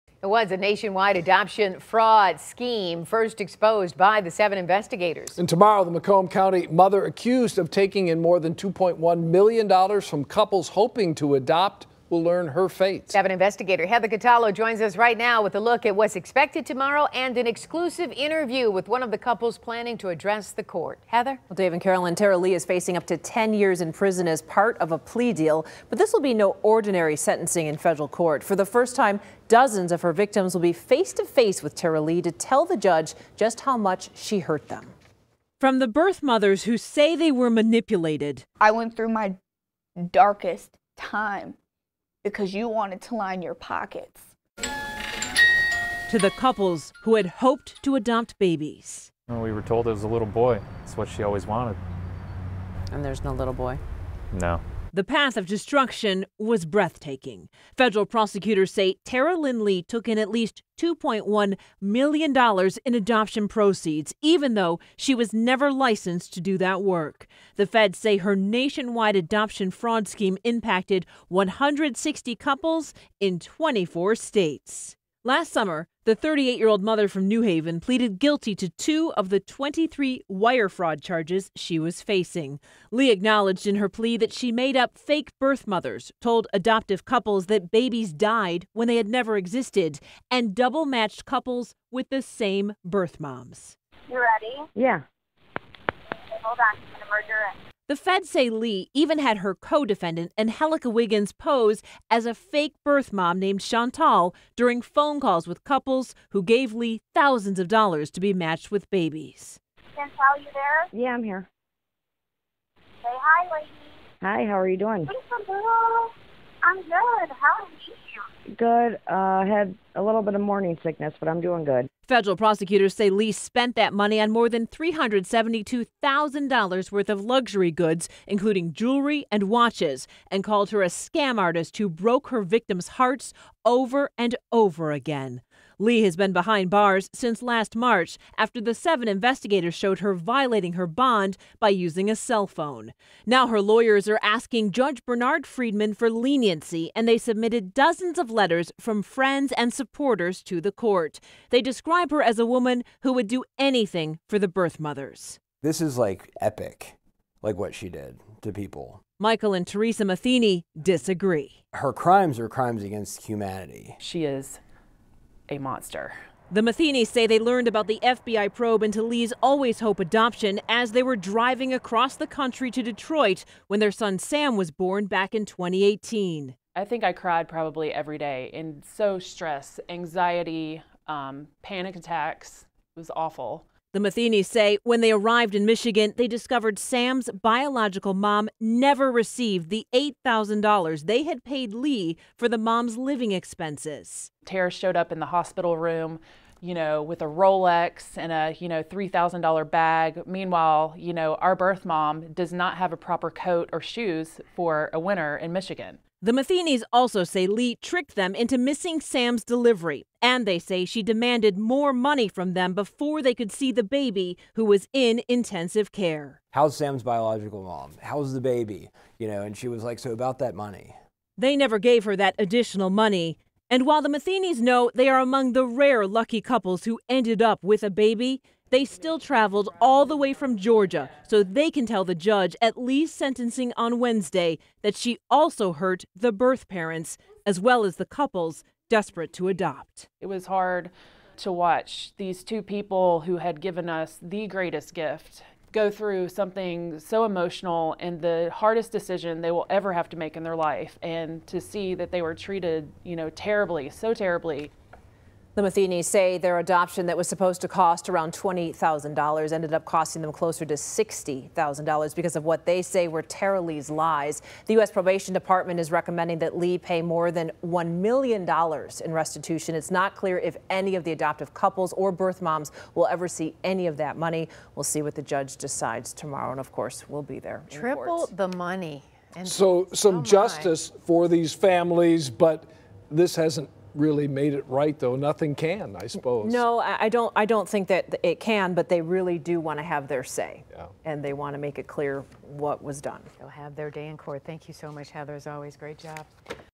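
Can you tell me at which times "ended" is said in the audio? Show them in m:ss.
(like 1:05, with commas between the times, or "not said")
3:47, 4:19.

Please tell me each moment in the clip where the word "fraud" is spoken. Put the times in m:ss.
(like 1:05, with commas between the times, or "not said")
0:01, 1:09, 1:20.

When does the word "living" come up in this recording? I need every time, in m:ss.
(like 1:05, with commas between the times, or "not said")
3:12.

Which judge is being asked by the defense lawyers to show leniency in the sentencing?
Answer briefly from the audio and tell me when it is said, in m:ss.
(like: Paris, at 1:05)
Bernard Friedman, at 2:24.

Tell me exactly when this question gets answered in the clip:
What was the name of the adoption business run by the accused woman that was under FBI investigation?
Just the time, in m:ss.
2:49.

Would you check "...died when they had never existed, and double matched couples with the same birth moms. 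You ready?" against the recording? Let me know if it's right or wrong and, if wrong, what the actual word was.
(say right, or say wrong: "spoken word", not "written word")
right.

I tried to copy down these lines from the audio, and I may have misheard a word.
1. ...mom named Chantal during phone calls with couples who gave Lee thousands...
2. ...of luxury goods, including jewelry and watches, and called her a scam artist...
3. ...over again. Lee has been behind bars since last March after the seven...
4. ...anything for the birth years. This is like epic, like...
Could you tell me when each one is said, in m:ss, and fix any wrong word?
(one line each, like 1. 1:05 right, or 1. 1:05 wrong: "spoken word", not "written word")
1. 1:43 right
2. 2:07 right
3. 2:14 right
4. 2:33 wrong: "mothers", not "years".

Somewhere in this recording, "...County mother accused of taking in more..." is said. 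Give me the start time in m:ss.
0:06.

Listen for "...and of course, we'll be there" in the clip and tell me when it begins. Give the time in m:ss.
4:36.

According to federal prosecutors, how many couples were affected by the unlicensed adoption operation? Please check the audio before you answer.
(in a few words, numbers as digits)
160.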